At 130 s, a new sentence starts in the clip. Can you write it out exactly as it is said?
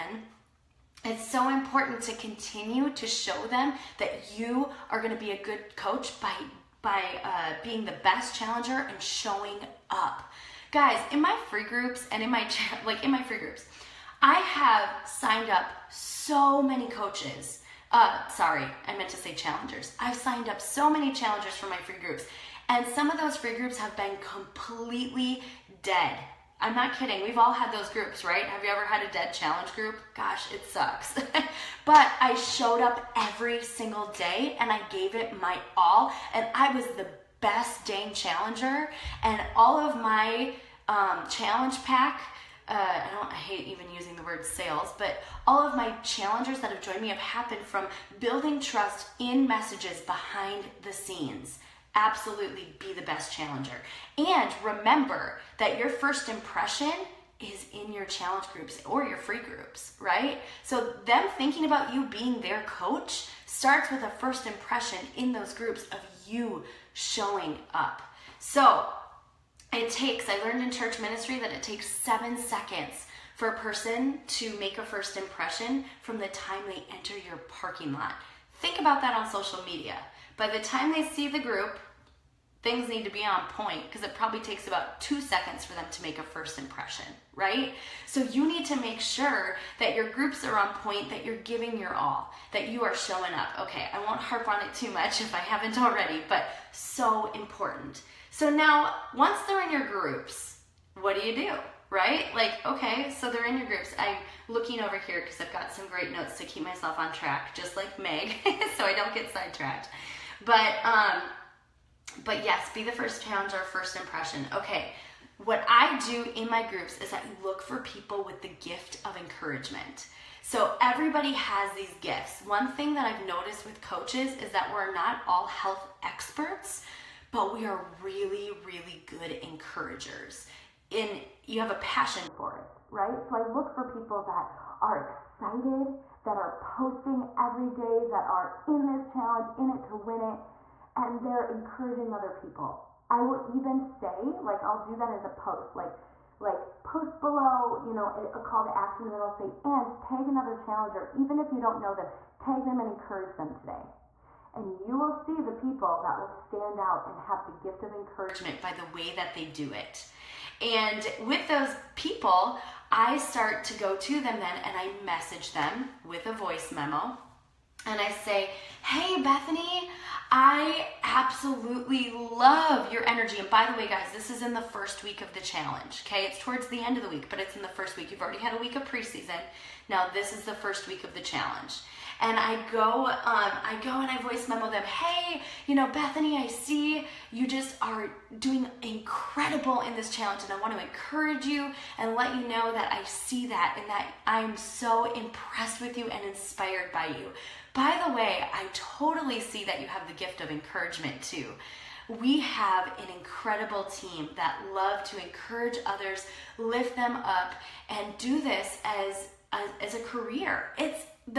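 In you have a passion for it, right?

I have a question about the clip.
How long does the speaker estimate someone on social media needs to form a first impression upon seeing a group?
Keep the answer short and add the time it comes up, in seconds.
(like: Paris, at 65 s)
2 seconds, at 85 s.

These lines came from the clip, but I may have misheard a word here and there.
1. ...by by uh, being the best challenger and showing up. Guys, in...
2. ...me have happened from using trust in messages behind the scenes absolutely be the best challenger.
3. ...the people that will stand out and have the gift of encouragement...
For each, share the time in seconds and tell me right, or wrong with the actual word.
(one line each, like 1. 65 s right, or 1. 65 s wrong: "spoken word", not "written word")
1. 6 s right
2. 47 s wrong: "building", not "using"
3. 155 s right.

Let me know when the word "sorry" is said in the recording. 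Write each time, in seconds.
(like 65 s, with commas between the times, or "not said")
18 s.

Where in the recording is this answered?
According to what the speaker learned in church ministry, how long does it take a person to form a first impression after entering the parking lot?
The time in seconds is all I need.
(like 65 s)
71 s.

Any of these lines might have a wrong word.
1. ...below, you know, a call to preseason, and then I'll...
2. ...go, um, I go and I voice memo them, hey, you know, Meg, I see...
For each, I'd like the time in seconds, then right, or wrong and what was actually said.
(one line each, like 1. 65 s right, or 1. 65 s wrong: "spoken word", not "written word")
1. 147 s wrong: "action", not "preseason"
2. 182 s wrong: "Bethany", not "Meg".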